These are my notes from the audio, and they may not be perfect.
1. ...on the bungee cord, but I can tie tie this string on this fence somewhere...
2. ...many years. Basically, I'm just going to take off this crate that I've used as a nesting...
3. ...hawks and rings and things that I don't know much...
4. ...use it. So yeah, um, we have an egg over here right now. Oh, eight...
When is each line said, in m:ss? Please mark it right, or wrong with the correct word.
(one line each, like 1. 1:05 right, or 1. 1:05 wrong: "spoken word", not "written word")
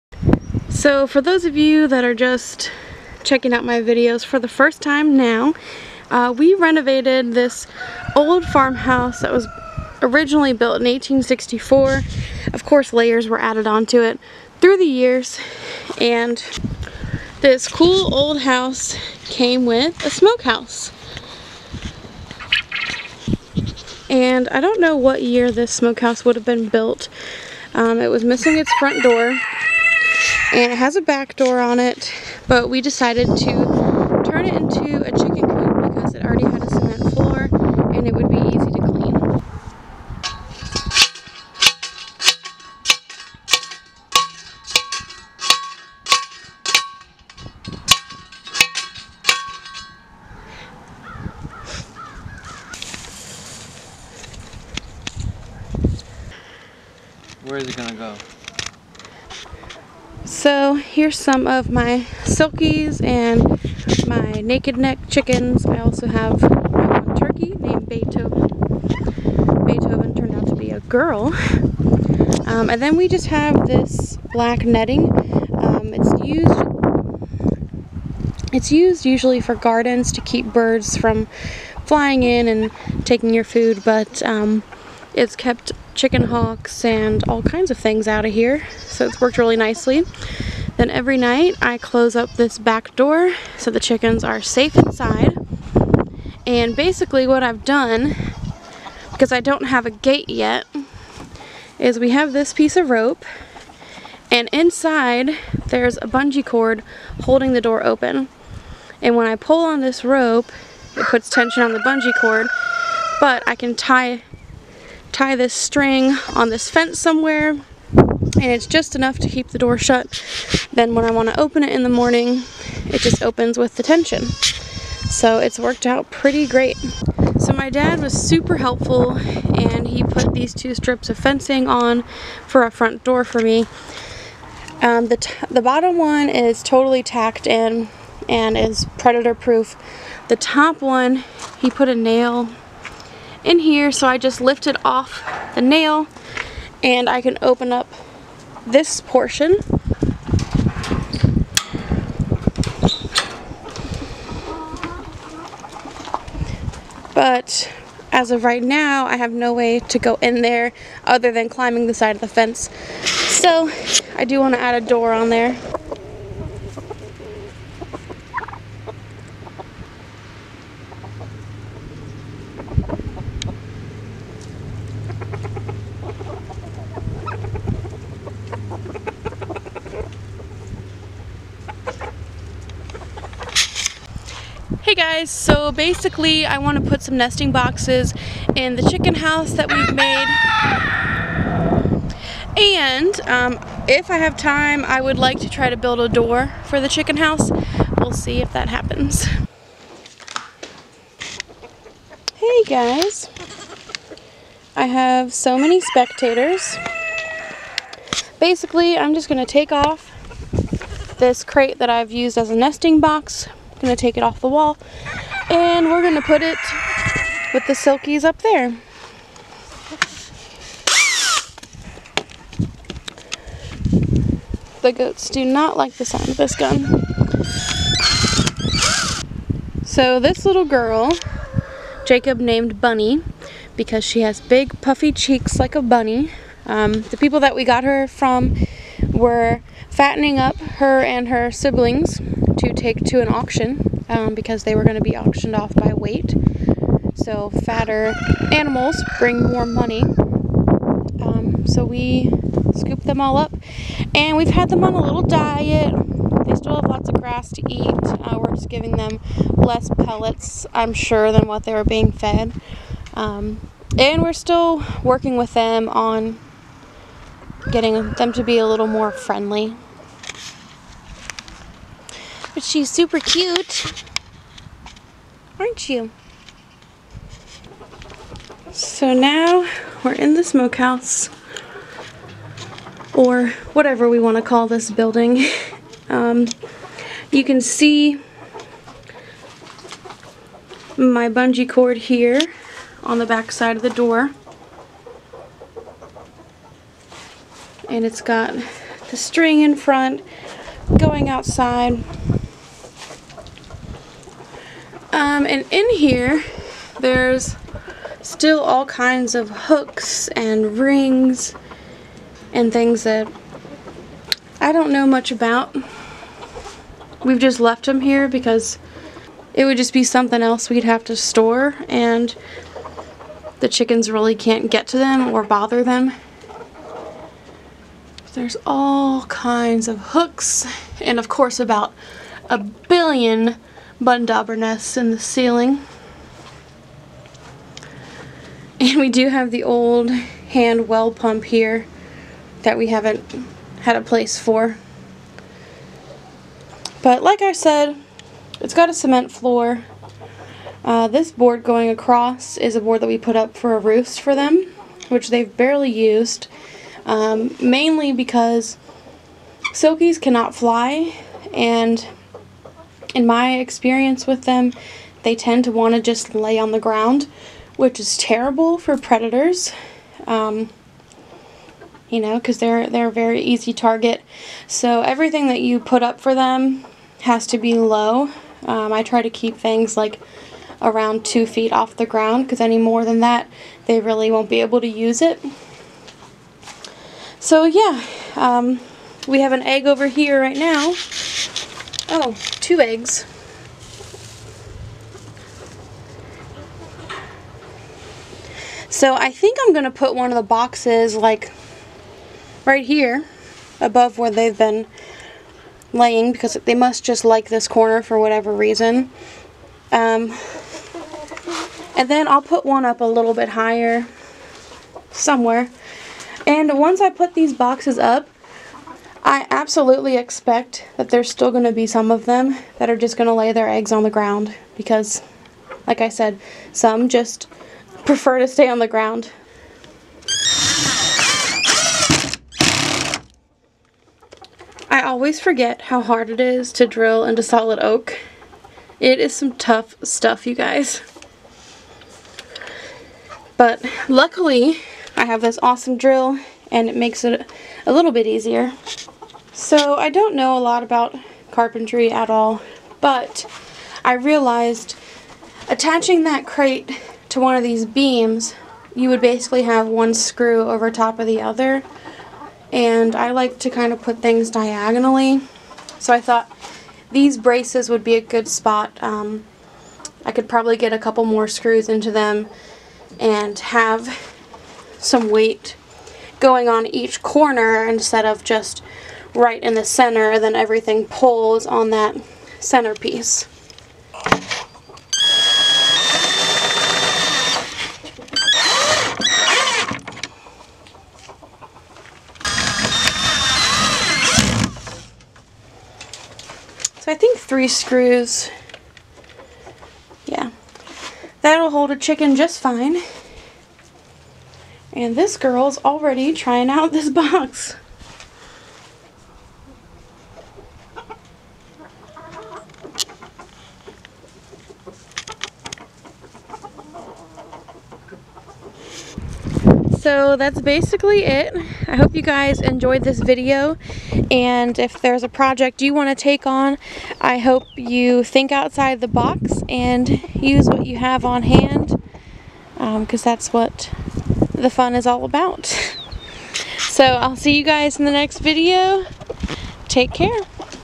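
1. 1:51 right
2. 3:25 wrong: "spectators", not "years"
3. 5:09 wrong: "hooks", not "hawks"
4. 6:24 wrong: "two", not "eight".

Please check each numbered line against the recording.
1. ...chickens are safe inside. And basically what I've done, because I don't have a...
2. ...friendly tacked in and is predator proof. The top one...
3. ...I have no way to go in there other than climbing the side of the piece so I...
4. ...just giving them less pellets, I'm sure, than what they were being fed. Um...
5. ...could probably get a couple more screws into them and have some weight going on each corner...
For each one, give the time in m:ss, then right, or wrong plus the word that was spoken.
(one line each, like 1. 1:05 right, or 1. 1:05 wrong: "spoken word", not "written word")
1. 1:33 right
2. 2:16 wrong: "totally", not "friendly"
3. 2:39 wrong: "fence", not "piece"
4. 4:18 right
5. 7:50 right.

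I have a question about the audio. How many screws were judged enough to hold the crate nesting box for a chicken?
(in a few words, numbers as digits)
3.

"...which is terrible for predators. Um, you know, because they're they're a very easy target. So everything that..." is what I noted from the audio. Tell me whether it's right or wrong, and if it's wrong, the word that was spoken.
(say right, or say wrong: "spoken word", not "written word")
right.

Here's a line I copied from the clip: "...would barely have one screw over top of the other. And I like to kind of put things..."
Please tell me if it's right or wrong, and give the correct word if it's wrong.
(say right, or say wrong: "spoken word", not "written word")
wrong: "basically", not "barely".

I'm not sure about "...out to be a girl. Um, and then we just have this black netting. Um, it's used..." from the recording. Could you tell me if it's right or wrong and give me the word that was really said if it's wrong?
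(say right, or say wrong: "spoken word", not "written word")
right.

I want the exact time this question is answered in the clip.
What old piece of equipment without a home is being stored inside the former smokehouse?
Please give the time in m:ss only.
5:40.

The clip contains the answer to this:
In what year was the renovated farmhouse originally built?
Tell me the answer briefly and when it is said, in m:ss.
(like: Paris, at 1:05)
1864, at 0:10.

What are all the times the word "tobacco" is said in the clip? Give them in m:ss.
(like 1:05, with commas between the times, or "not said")
not said.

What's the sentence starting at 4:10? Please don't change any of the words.
Um, so we scooped them all up and we've had them on a little diet.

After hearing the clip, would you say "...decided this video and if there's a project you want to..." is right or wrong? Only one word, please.
wrong.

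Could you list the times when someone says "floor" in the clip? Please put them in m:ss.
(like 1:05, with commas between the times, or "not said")
0:37, 5:49.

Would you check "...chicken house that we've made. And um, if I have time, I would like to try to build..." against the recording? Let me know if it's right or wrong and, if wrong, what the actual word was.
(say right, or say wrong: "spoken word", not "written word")
right.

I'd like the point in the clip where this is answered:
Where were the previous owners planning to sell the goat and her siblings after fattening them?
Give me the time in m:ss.
4:03.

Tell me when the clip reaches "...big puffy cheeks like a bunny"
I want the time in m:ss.
3:54.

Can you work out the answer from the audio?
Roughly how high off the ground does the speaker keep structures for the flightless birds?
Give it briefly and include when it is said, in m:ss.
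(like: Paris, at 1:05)
2 feet, at 6:21.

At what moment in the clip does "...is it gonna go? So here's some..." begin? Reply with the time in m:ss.
0:57.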